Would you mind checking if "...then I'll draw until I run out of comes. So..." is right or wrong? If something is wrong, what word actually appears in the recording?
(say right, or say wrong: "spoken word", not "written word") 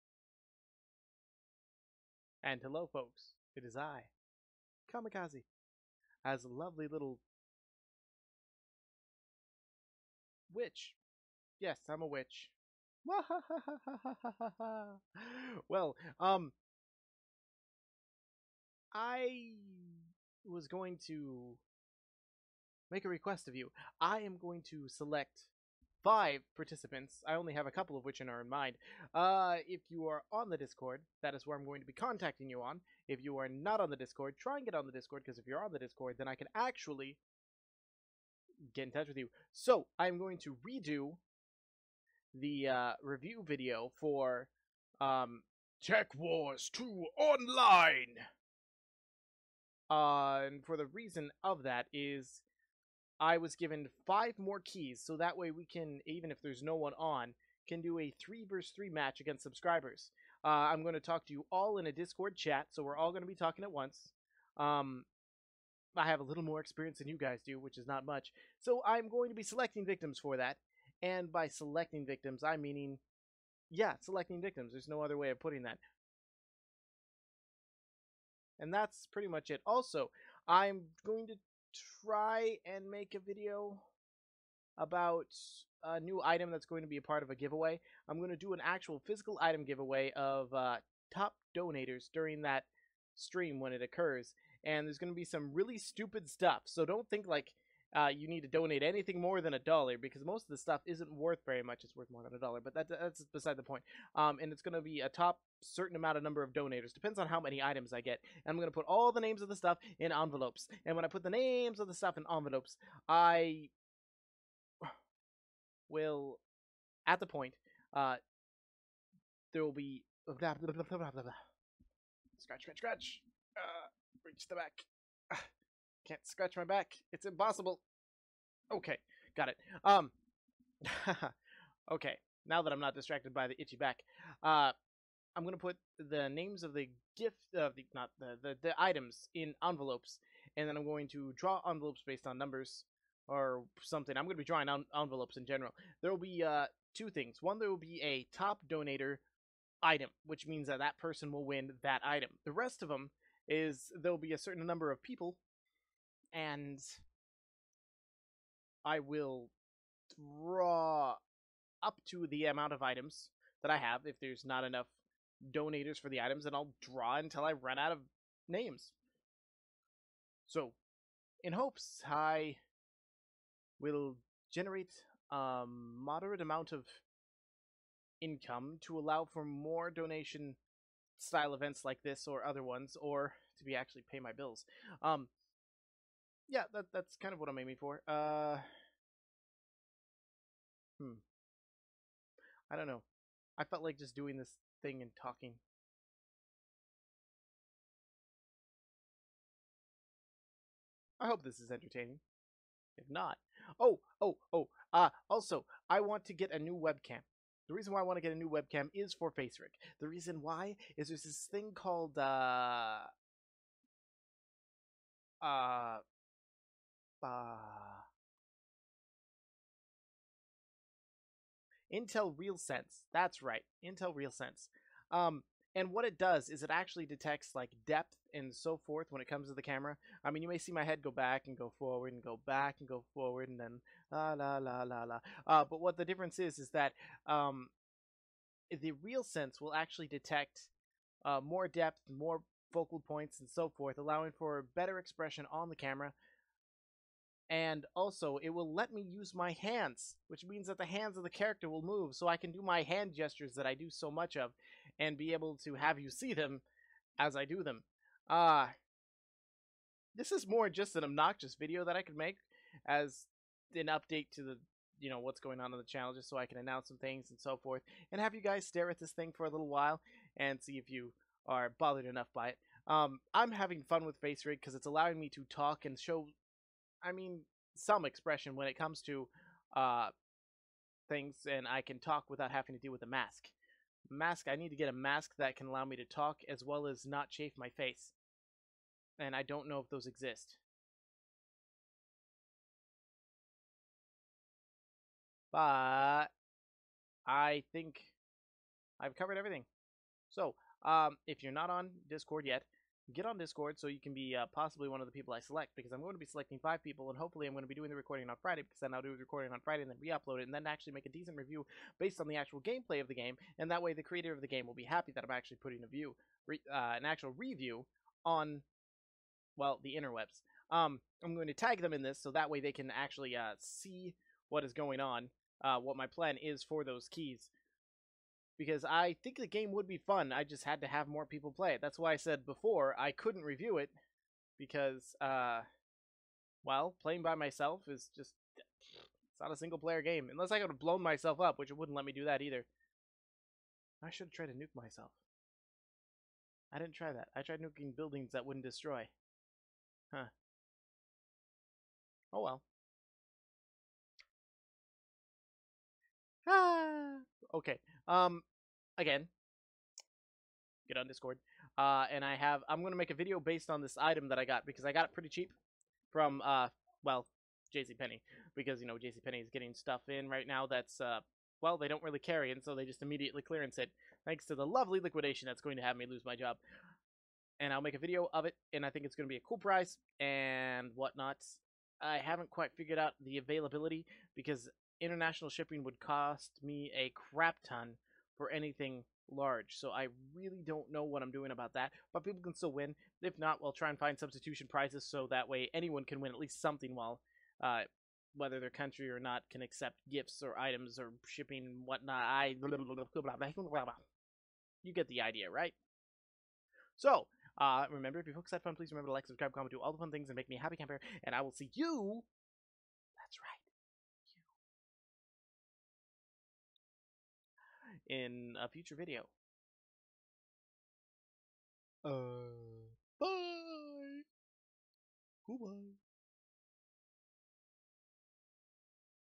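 wrong: "names", not "comes".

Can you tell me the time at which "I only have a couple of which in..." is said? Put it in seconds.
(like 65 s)
27 s.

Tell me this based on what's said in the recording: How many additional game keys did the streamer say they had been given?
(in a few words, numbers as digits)
5.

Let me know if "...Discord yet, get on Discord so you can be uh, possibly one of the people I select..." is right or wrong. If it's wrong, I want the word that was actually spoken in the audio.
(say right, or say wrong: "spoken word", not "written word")
right.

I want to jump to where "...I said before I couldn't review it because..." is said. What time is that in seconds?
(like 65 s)
332 s.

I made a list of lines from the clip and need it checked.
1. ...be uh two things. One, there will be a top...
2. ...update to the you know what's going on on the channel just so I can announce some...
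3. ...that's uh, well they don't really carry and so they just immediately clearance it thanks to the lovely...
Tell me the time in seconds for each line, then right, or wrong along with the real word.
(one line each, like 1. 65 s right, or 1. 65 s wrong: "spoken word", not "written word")
1. 146 s right
2. 263 s right
3. 370 s right.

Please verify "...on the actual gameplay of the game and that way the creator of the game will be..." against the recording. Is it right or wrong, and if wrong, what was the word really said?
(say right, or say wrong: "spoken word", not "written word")
right.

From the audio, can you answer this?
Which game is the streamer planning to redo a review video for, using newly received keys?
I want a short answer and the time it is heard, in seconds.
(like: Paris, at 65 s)
Tech Wars 2 Online, at 45 s.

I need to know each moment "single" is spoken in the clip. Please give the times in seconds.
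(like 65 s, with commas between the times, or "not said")
339 s.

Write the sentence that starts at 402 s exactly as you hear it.
I blah, blah, blah, You get the idea, right?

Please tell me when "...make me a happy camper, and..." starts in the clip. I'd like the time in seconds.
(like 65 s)
410 s.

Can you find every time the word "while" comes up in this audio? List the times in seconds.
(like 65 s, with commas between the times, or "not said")
269 s, 396 s.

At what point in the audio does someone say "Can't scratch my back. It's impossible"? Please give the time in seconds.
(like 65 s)
126 s.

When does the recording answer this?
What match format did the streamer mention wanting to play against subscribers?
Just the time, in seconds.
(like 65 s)
58 s.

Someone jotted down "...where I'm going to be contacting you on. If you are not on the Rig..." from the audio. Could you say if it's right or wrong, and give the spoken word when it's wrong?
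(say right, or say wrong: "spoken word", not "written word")
wrong: "Discord", not "Rig".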